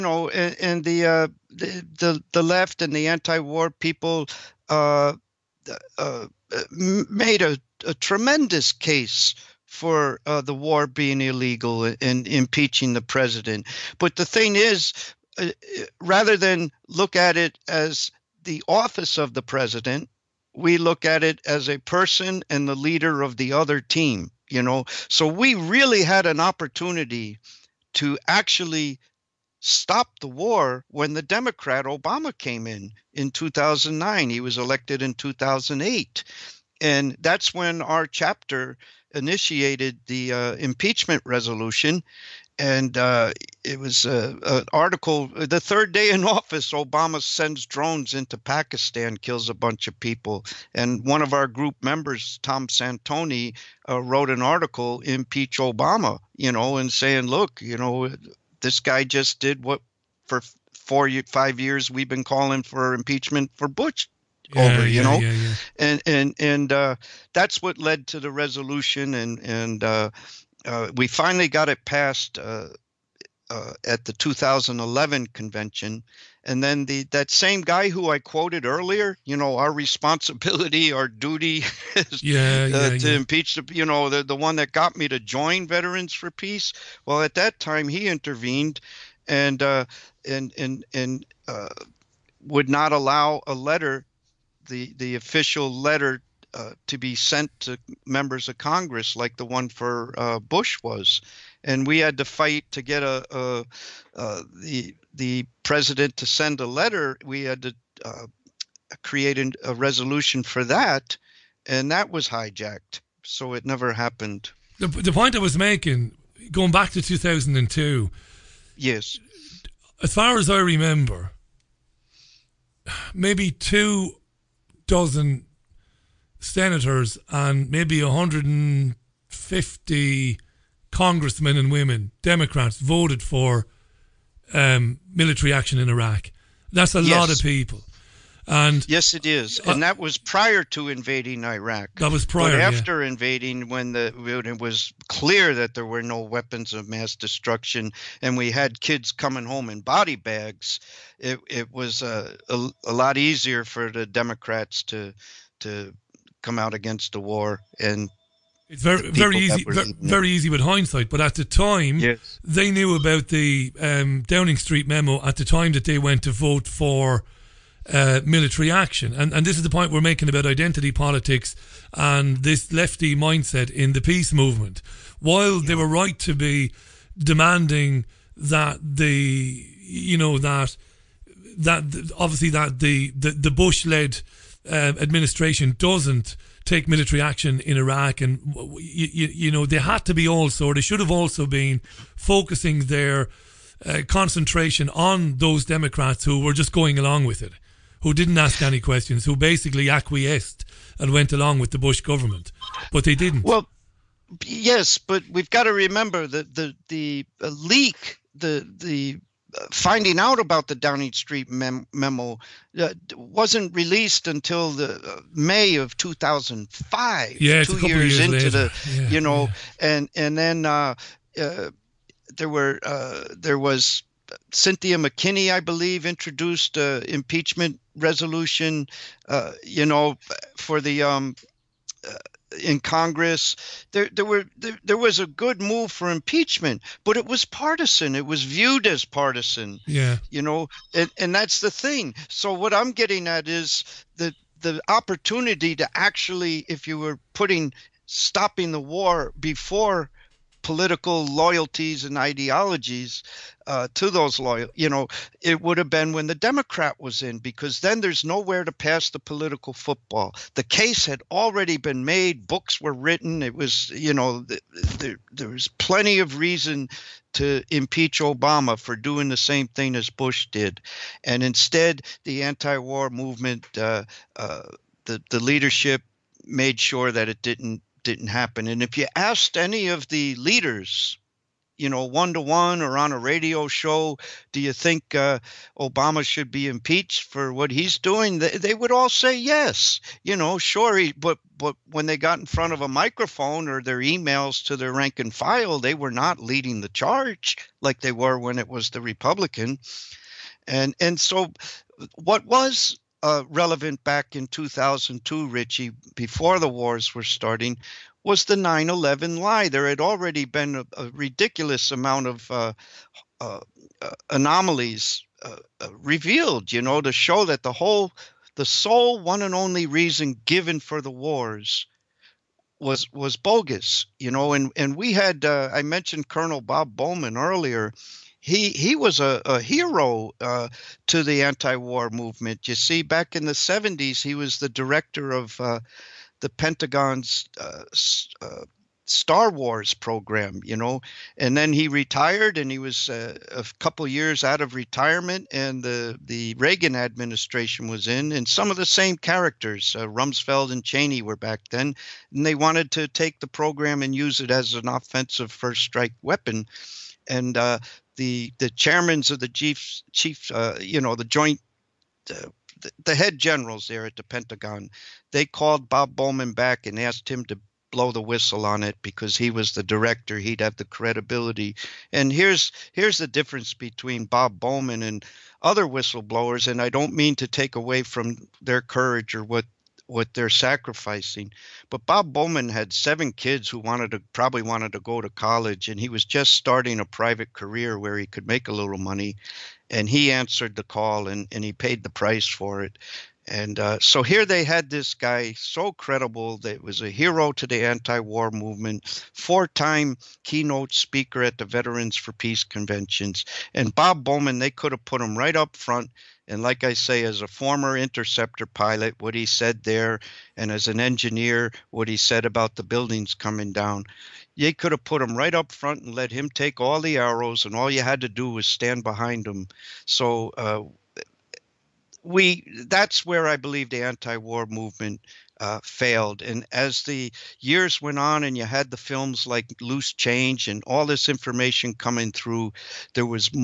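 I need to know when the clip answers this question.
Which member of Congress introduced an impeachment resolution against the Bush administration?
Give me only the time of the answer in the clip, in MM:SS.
03:44.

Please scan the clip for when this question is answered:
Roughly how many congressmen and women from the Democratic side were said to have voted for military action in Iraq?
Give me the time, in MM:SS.
02:08.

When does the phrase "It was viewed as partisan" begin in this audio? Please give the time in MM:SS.
03:58.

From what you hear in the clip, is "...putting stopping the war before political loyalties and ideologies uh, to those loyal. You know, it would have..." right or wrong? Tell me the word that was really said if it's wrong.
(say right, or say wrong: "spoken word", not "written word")
right.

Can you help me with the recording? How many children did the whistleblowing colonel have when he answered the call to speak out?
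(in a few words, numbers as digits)
7.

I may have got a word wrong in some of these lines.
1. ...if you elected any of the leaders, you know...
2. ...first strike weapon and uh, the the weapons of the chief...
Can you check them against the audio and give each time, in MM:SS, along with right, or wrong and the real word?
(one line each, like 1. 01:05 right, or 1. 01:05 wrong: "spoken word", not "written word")
1. 04:38 wrong: "asked", not "elected"
2. 05:55 wrong: "chairmans", not "weapons".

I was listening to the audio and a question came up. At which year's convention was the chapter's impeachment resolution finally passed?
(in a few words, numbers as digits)
2011.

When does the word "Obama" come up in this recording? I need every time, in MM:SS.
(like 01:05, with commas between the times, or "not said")
00:31, 00:46, 00:55, 04:28, 04:45.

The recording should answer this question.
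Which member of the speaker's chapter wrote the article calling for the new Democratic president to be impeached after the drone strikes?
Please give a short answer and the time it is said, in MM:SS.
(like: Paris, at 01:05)
Tom Santoni, at 00:52.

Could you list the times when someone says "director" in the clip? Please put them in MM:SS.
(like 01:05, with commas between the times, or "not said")
05:34, 06:09.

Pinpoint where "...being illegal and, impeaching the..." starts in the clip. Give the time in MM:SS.
00:10.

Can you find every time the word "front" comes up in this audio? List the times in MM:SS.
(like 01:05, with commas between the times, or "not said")
04:52, 06:45, 06:55.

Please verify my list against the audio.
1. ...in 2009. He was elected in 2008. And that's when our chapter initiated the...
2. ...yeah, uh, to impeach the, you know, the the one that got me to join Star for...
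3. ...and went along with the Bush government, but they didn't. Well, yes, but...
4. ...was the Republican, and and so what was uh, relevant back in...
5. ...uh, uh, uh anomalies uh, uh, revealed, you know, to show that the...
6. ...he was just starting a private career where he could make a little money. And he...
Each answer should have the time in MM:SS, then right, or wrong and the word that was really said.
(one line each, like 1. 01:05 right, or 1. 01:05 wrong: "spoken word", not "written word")
1. 00:33 right
2. 01:22 wrong: "Veterans", not "Star"
3. 03:20 right
4. 04:58 right
5. 05:12 right
6. 06:25 right.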